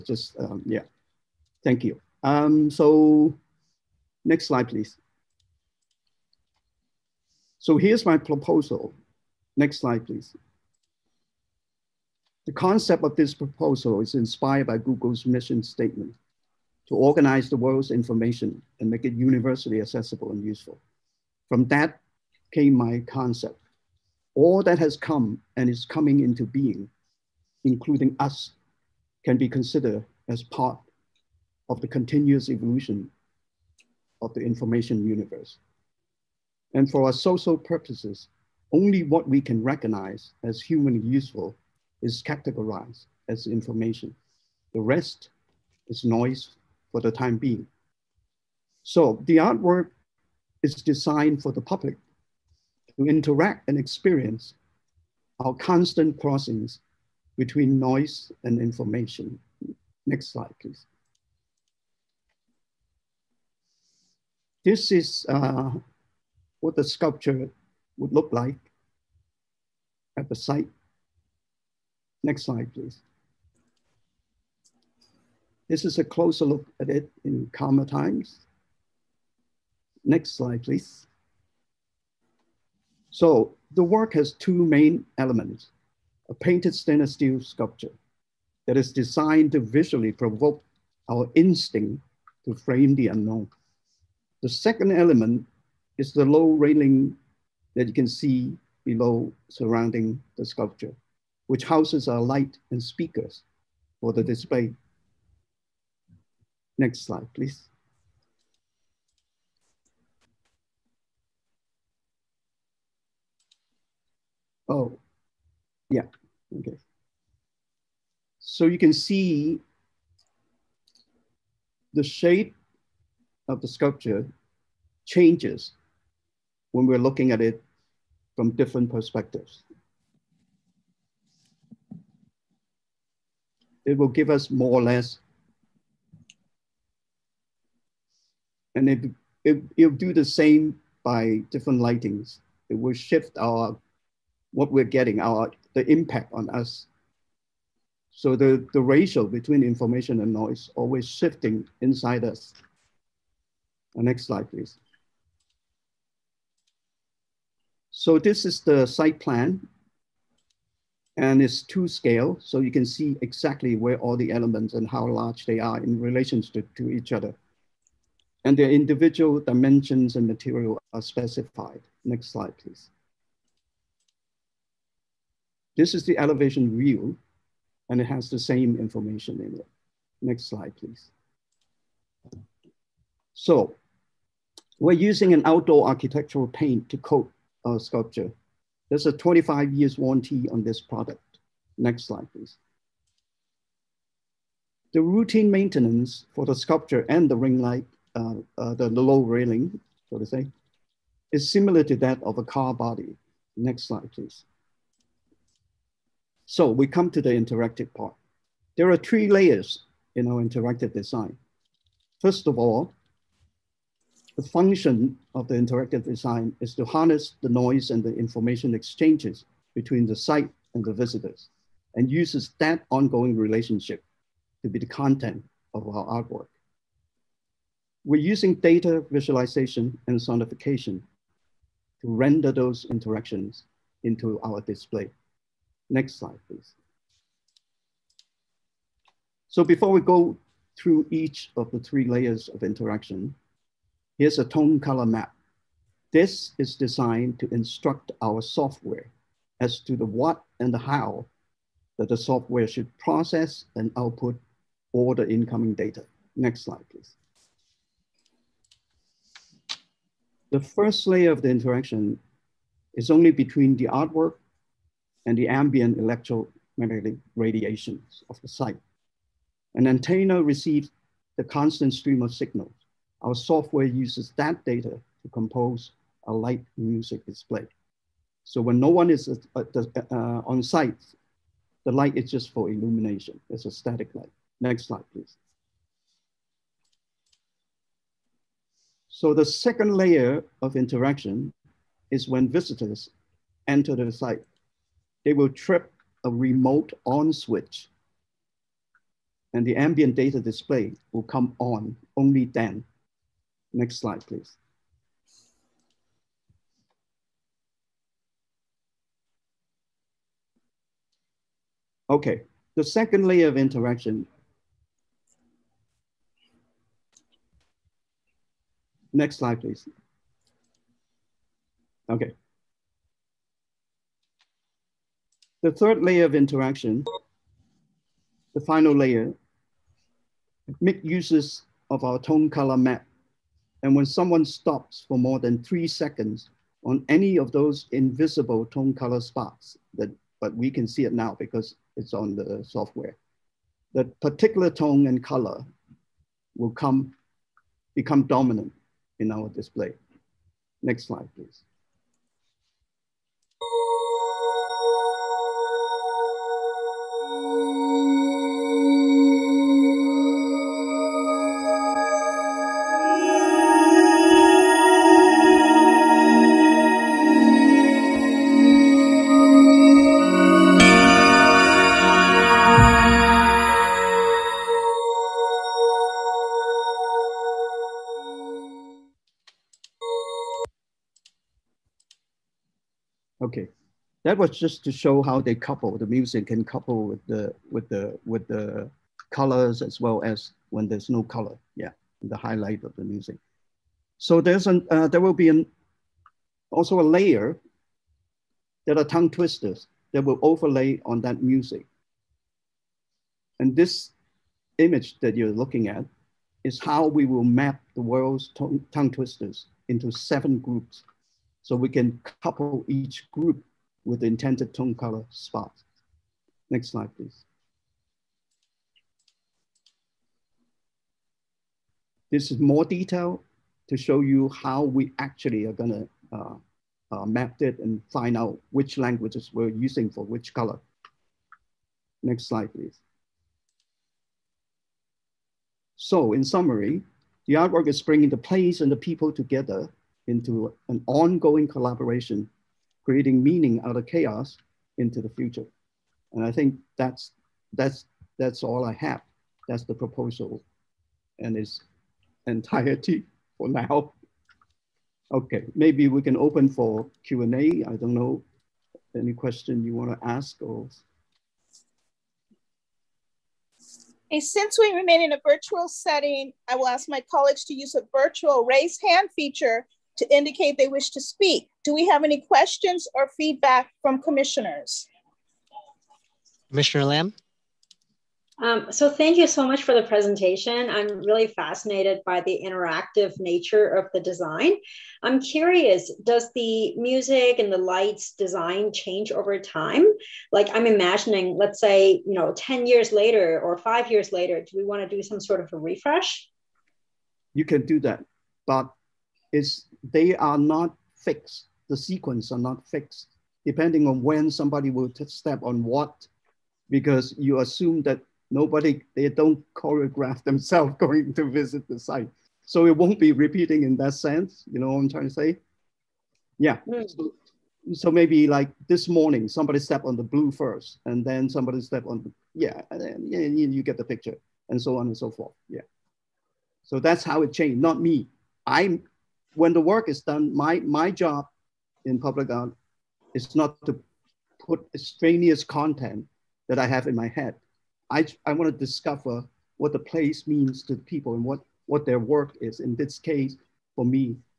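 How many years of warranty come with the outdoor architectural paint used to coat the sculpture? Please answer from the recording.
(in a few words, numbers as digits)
25.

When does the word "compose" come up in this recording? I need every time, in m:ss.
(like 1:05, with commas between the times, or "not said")
4:35.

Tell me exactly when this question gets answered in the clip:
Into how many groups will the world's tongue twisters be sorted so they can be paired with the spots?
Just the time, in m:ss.
6:50.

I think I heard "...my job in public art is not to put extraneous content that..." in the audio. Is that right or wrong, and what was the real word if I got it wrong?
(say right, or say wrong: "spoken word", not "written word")
right.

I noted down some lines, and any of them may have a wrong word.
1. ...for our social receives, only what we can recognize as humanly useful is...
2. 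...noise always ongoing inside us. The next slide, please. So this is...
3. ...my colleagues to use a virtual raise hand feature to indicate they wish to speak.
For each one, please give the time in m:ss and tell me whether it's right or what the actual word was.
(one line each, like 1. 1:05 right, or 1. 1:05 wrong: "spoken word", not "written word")
1. 0:36 wrong: "purposes", not "receives"
2. 2:30 wrong: "shifting", not "ongoing"
3. 7:47 right.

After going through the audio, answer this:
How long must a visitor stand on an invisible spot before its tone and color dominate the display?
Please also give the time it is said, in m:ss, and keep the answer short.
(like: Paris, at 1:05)
3 seconds, at 5:35.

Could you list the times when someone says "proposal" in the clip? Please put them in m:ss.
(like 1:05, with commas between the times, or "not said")
0:08, 0:13, 7:29.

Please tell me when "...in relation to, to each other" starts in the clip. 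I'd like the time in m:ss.
2:45.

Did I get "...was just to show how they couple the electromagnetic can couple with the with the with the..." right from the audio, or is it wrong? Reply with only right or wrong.
wrong.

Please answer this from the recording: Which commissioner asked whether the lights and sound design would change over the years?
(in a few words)
Commissioner Lamb.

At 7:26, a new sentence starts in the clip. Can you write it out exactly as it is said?
And I think that's, that's, that's all I have.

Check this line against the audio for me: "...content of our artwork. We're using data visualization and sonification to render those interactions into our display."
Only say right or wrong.
right.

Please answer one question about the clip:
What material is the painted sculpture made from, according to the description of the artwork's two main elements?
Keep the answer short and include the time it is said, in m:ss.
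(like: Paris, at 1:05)
Stainless steel, at 1:26.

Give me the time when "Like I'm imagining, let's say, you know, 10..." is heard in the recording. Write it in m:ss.
8:10.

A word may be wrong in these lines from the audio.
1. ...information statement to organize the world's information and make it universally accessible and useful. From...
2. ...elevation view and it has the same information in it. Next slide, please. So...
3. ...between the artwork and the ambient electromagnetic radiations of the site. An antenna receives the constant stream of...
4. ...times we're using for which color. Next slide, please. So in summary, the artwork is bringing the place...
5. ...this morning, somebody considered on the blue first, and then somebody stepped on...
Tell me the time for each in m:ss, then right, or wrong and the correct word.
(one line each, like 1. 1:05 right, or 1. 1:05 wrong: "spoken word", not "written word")
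1. 0:15 wrong: "mission", not "information"
2. 2:56 right
3. 4:23 right
4. 7:08 wrong: "languages", not "times"
5. 8:38 wrong: "stepped", not "considered".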